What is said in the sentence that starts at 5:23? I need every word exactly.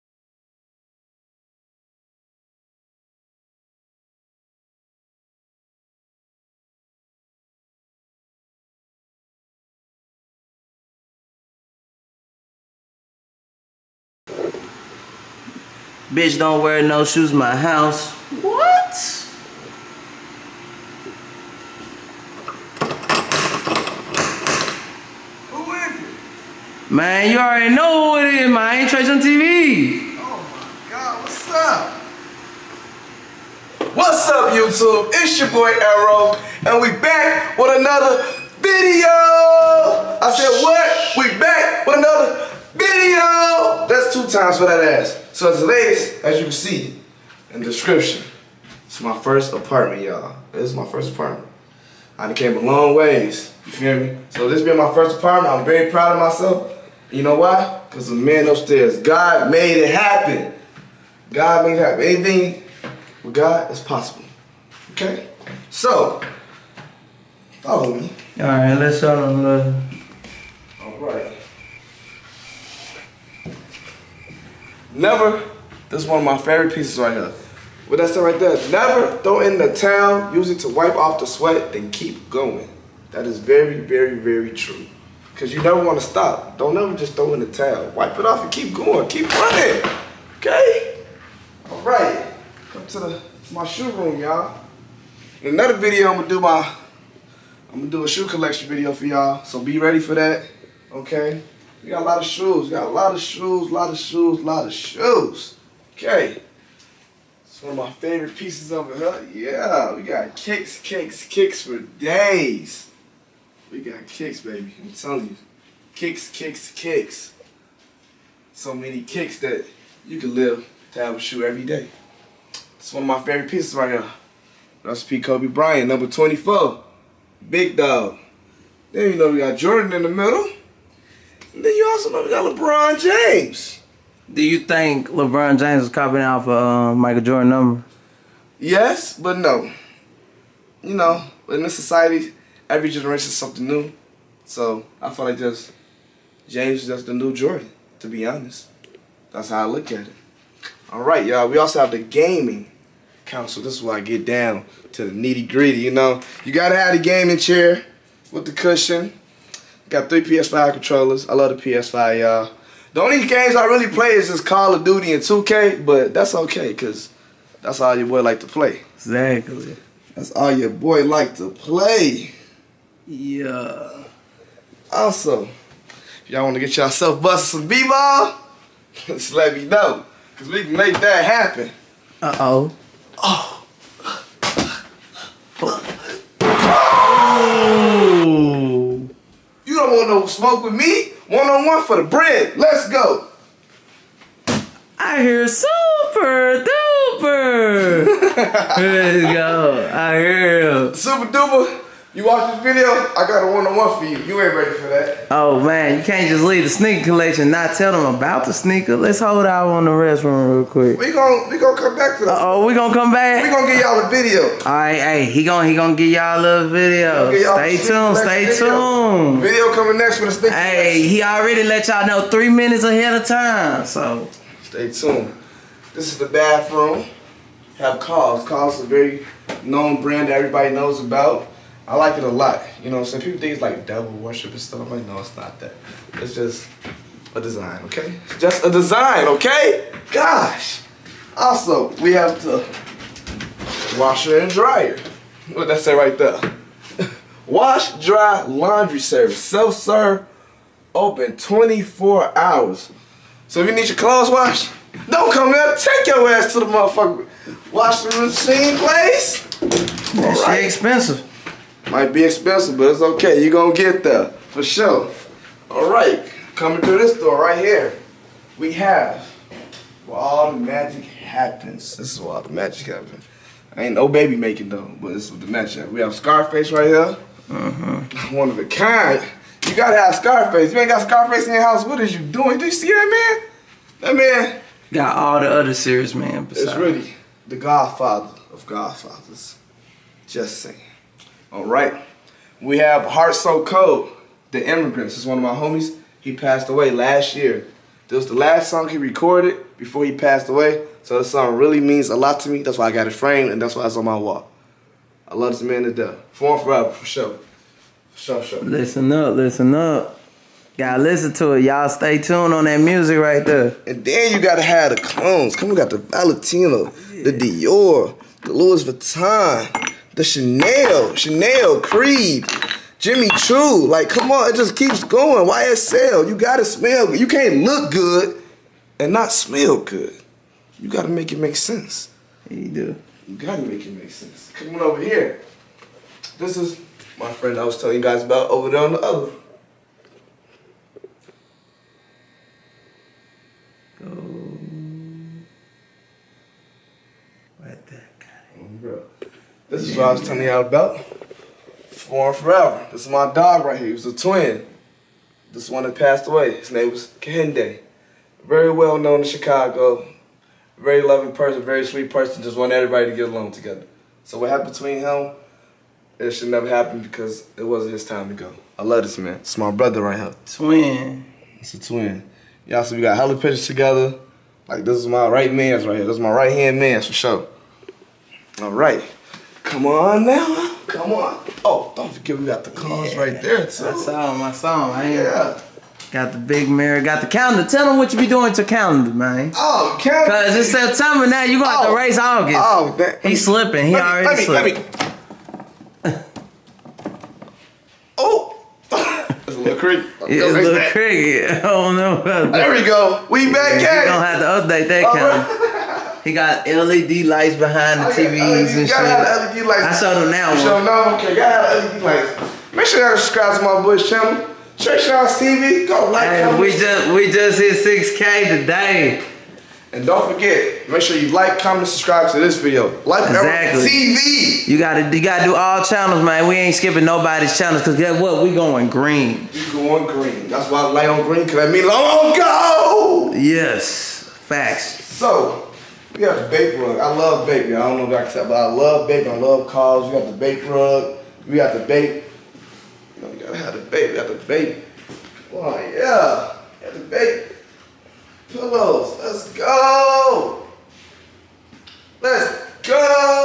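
Like, come on, it just keeps going.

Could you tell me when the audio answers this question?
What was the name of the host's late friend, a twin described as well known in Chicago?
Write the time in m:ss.
5:57.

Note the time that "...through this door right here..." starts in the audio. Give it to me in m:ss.
4:26.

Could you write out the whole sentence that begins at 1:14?
Never, this is one of my favorite pieces right here.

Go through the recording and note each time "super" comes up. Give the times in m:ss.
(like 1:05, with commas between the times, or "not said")
3:15, 3:20.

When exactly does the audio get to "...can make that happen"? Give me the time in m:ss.
3:00.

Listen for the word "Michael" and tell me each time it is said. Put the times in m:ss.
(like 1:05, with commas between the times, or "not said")
2:16.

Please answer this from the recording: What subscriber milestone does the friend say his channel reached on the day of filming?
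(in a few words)
6K.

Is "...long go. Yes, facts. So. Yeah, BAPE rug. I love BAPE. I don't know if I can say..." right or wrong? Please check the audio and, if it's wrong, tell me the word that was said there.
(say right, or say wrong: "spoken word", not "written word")
right.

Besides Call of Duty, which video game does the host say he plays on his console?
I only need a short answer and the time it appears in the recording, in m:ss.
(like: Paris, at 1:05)
2K, at 2:45.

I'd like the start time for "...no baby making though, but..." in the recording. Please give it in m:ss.
4:33.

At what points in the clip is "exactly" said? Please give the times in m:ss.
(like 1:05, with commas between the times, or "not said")
2:48, 7:03.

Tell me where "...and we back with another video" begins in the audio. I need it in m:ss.
0:36.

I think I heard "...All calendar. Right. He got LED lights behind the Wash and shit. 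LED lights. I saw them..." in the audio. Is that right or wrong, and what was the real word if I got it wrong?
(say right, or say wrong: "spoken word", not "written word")
wrong: "TVs", not "Wash".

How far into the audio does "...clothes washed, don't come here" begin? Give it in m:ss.
4:13.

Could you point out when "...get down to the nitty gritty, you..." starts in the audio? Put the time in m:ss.
2:33.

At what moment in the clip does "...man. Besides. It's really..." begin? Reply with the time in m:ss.
4:46.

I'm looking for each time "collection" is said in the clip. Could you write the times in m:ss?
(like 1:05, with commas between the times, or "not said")
1:38, 3:27, 3:40.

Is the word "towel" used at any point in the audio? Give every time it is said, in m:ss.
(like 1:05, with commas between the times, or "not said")
1:19, 1:27.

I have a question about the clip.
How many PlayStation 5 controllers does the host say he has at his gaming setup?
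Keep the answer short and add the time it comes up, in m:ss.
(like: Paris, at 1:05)
3, at 2:40.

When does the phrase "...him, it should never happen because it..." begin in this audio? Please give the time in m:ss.
6:04.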